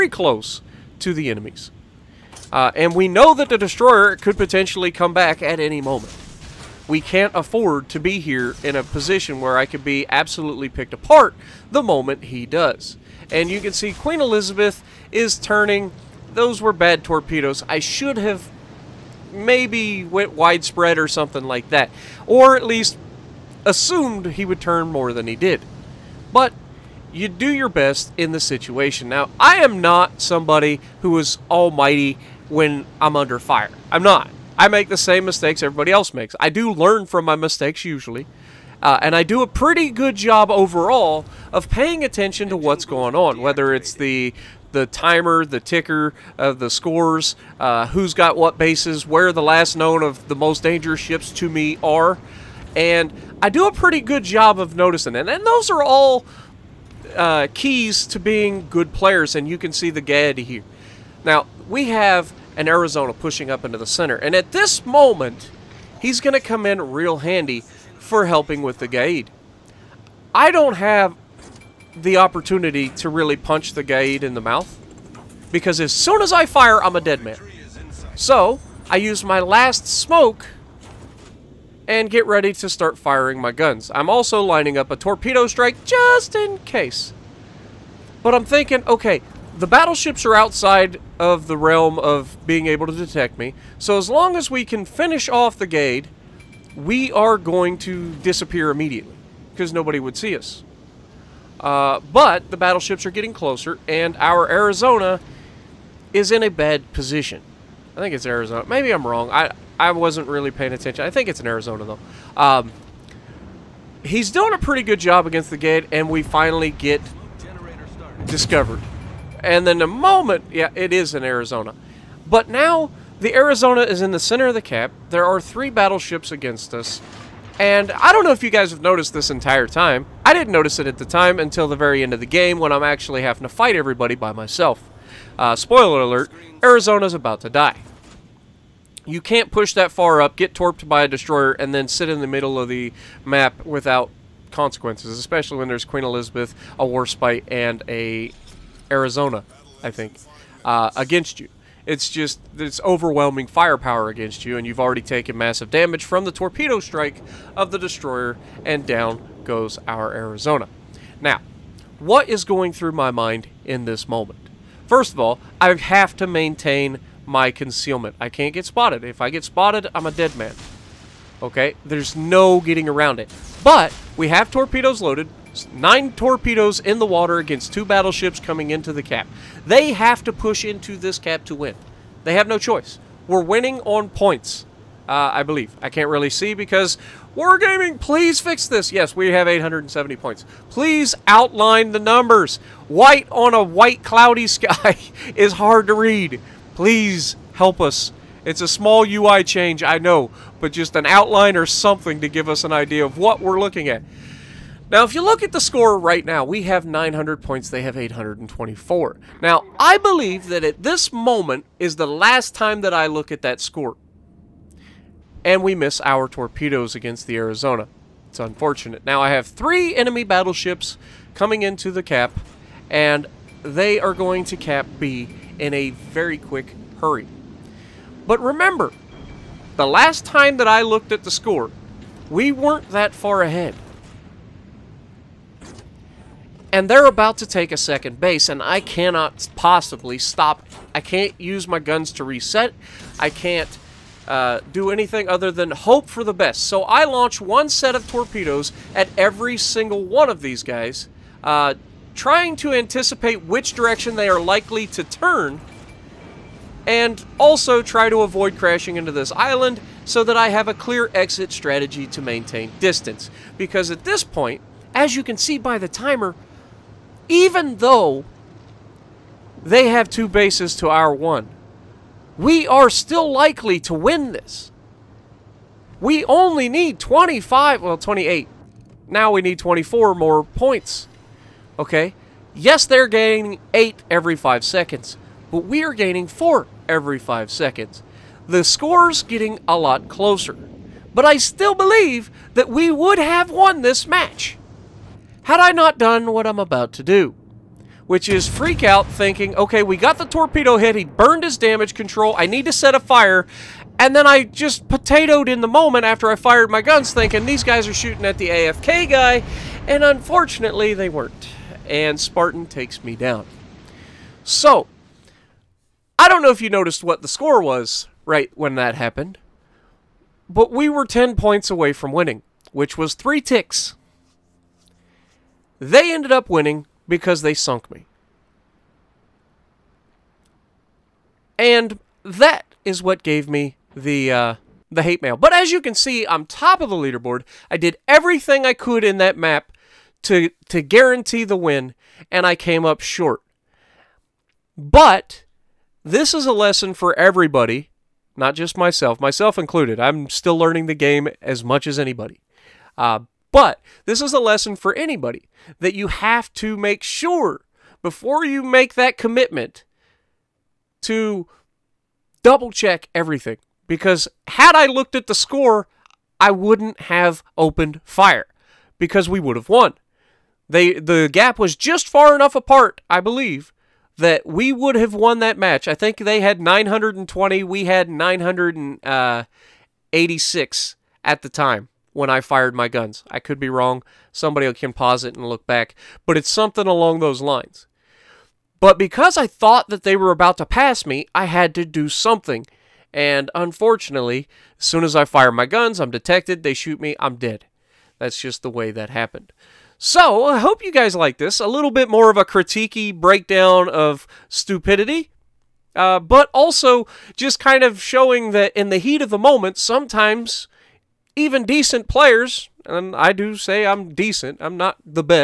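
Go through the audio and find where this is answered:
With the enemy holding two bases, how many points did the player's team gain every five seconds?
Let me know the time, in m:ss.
4:46.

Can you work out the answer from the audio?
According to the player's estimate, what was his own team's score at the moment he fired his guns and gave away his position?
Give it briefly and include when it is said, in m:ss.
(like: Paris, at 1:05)
986, at 6:18.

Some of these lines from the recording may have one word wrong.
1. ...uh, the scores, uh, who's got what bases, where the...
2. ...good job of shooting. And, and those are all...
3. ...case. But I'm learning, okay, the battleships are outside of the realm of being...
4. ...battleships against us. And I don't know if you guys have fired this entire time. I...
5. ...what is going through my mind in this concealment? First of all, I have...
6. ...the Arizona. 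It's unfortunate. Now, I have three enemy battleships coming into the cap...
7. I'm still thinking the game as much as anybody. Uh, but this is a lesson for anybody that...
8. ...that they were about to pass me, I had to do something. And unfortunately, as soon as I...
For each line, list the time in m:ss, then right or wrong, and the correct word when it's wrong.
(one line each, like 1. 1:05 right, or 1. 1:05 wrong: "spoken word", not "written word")
1. 0:46 right
2. 0:54 wrong: "noticing", not "shooting"
3. 1:26 wrong: "thinking", not "learning"
4. 2:05 wrong: "noticed", not "fired"
5. 2:41 wrong: "moment", not "concealment"
6. 3:37 right
7. 5:49 wrong: "learning", not "thinking"
8. 6:29 right.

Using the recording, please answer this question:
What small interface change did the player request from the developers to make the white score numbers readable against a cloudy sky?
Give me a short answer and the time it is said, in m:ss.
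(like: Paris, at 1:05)
An outline, at 3:11.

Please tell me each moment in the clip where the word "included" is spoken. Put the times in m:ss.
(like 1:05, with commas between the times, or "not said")
5:49.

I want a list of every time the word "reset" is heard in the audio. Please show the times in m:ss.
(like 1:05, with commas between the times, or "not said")
4:02.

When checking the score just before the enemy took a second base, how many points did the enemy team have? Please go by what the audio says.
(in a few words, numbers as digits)
824.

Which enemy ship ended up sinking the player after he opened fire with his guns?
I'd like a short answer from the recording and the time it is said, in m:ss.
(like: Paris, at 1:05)
Spartan, at 5:12.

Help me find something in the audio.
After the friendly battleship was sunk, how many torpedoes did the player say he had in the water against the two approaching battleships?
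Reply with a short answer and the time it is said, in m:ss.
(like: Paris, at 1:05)
9, at 2:55.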